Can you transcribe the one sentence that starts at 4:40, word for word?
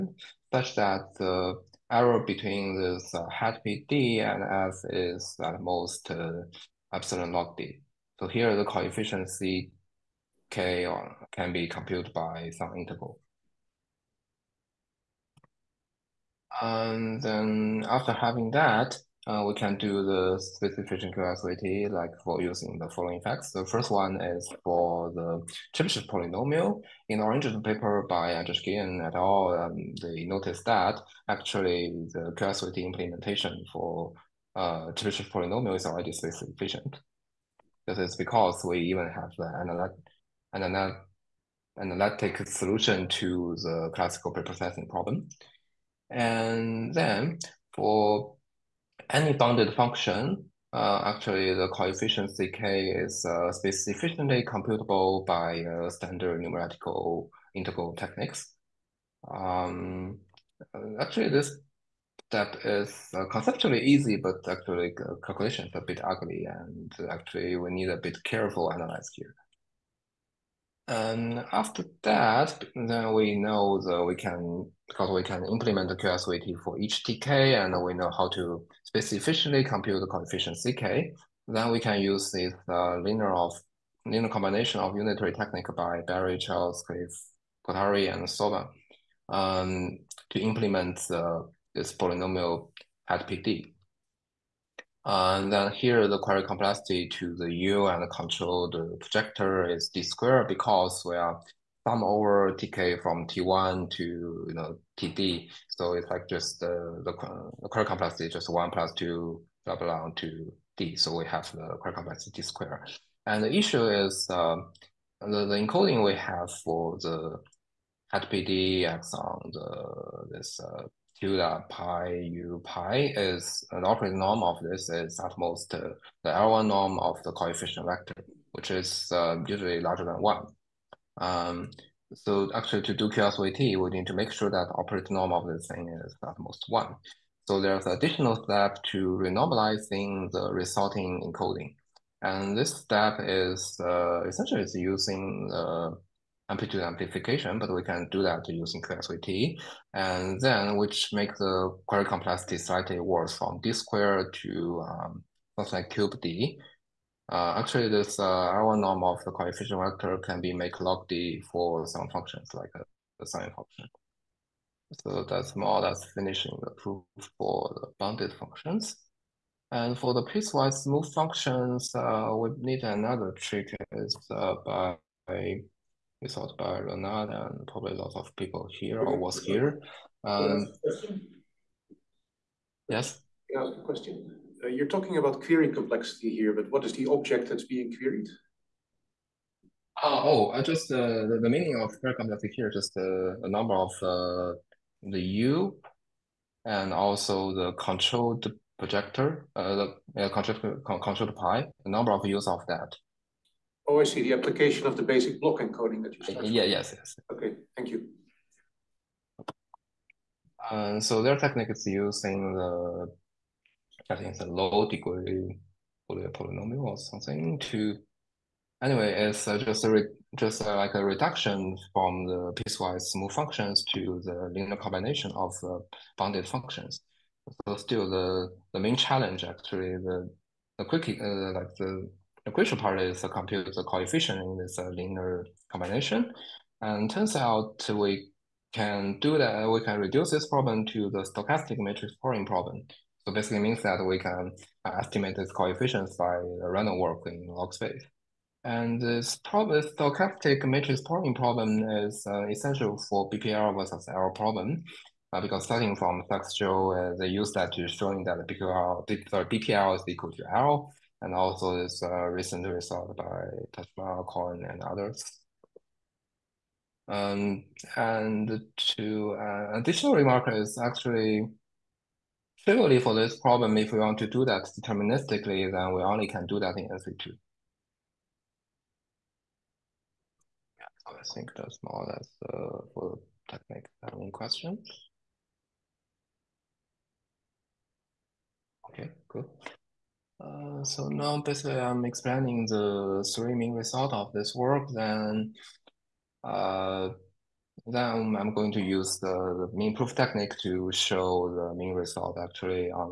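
Yeah, so I think that's more or less uh, for the technique questions.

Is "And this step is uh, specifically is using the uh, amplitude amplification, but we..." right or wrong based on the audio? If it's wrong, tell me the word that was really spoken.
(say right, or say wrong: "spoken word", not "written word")
wrong: "essentially", not "specifically".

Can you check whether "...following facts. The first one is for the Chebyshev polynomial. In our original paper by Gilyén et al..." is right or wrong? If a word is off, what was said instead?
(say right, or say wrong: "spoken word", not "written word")
right.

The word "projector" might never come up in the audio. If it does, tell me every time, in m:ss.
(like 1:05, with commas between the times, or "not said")
1:38, 3:18.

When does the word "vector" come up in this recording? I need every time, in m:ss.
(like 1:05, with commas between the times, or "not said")
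2:07, 2:39.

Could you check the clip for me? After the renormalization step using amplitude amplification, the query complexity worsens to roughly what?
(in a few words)
cube D.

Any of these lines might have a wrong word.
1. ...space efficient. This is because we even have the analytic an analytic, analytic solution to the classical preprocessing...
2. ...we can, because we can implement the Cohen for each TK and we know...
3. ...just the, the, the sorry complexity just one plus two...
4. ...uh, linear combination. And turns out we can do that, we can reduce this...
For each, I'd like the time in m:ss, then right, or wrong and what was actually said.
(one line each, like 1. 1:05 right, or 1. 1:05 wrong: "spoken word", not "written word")
1. 0:36 right
2. 1:14 wrong: "QSVT", not "Cohen"
3. 1:46 wrong: "query", not "sorry"
4. 3:54 right.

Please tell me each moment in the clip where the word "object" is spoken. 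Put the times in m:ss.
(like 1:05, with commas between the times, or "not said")
3:07.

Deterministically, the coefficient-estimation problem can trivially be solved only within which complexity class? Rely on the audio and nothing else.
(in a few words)
NC2.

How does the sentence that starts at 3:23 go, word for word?
Oh, I see, the application of the basic block encoding that you started.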